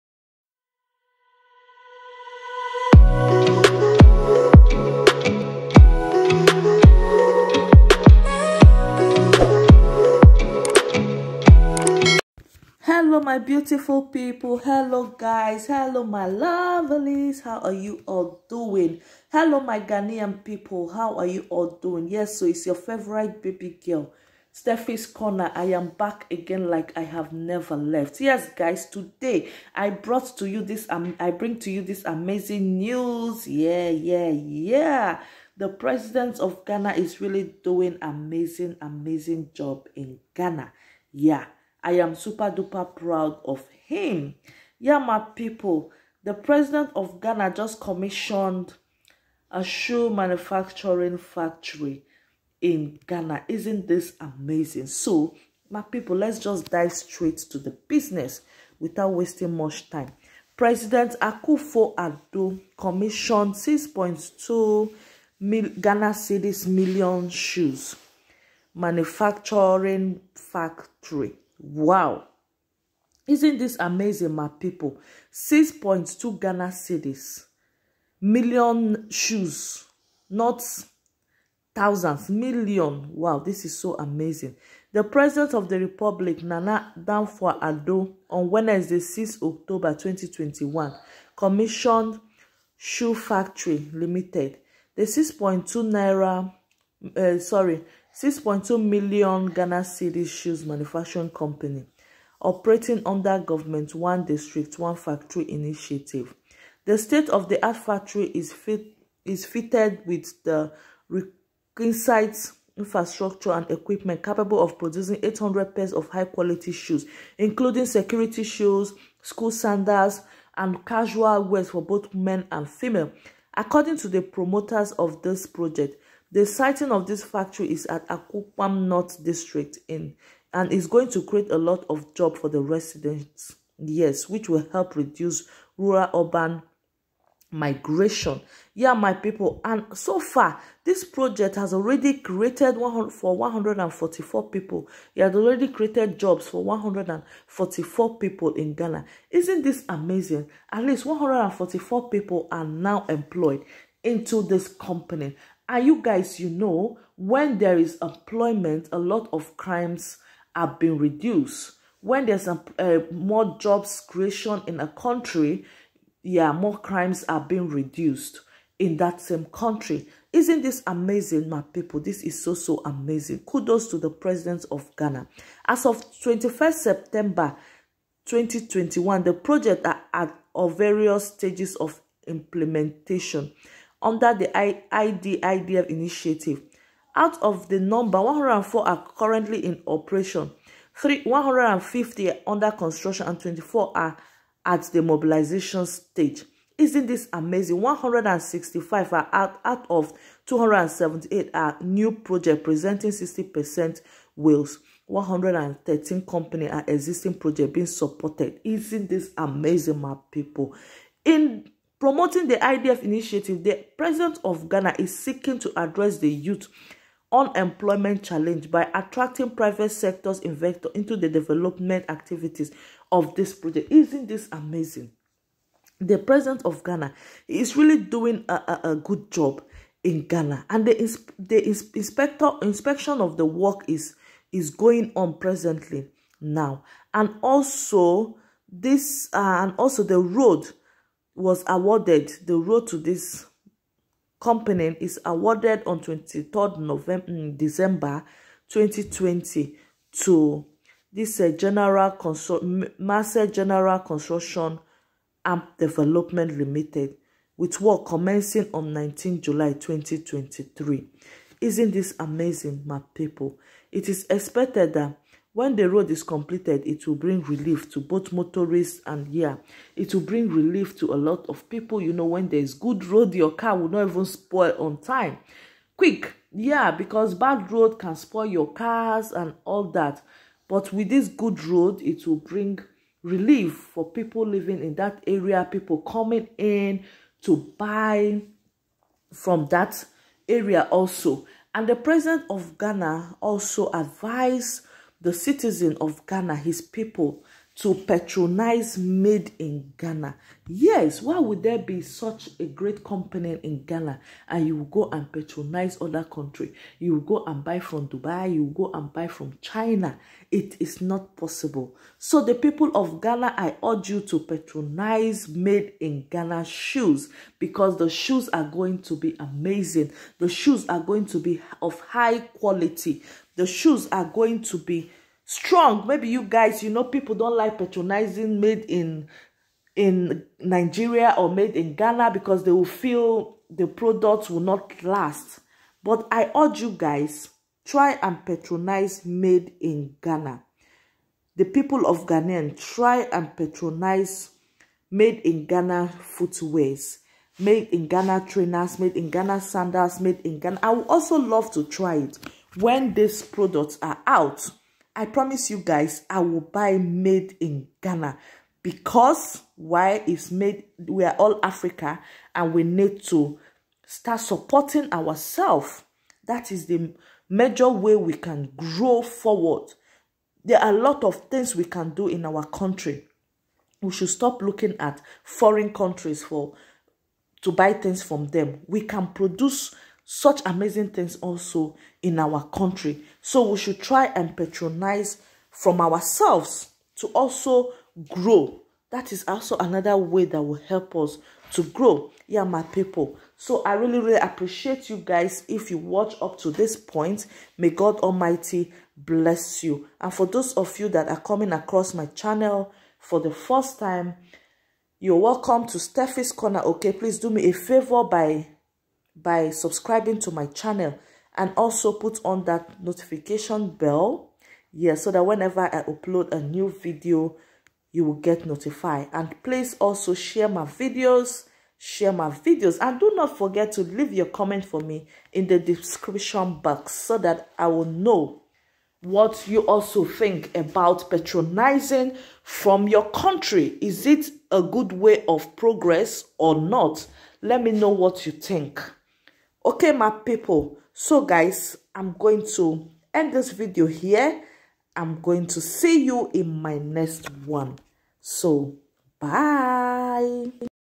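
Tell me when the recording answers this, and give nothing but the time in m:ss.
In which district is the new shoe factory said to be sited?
2:08.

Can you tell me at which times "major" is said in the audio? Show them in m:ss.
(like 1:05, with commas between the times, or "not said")
6:07.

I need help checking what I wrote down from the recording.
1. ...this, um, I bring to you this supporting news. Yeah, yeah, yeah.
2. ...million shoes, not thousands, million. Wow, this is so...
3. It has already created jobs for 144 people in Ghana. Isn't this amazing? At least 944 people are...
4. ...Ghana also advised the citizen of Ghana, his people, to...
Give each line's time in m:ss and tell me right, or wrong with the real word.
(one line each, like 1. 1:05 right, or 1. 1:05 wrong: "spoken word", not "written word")
1. 0:30 wrong: "amazing", not "supporting"
2. 1:18 right
3. 2:25 wrong: "144", not "944"
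4. 4:52 right.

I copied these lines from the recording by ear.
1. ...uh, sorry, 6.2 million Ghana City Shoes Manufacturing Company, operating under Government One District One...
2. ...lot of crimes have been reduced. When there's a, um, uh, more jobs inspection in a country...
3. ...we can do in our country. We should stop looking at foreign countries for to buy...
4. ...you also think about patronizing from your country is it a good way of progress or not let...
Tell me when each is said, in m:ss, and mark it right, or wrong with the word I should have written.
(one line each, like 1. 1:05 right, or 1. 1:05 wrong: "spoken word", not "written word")
1. 1:37 right
2. 2:38 wrong: "creation", not "inspection"
3. 6:11 right
4. 7:09 right.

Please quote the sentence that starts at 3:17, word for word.
165 are out, out of 278 are new project presenting 60% wills.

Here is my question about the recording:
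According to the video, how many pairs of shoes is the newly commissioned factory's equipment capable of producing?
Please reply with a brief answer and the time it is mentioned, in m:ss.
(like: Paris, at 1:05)
800, at 1:55.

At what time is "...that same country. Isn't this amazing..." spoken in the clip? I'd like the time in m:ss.
2:48.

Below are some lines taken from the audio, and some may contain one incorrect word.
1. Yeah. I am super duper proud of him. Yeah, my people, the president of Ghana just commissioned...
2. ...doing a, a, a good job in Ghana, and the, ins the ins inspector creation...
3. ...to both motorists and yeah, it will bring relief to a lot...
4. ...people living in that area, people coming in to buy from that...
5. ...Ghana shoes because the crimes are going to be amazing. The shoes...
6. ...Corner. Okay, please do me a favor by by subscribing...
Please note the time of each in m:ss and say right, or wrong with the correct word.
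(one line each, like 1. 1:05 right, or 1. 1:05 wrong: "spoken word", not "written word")
1. 0:41 right
2. 3:47 wrong: "inspection", not "creation"
3. 4:27 right
4. 4:44 right
5. 5:16 wrong: "shoes", not "crimes"
6. 6:46 right.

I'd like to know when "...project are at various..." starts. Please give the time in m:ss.
2:59.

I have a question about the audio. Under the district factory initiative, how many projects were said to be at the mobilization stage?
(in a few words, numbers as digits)
24.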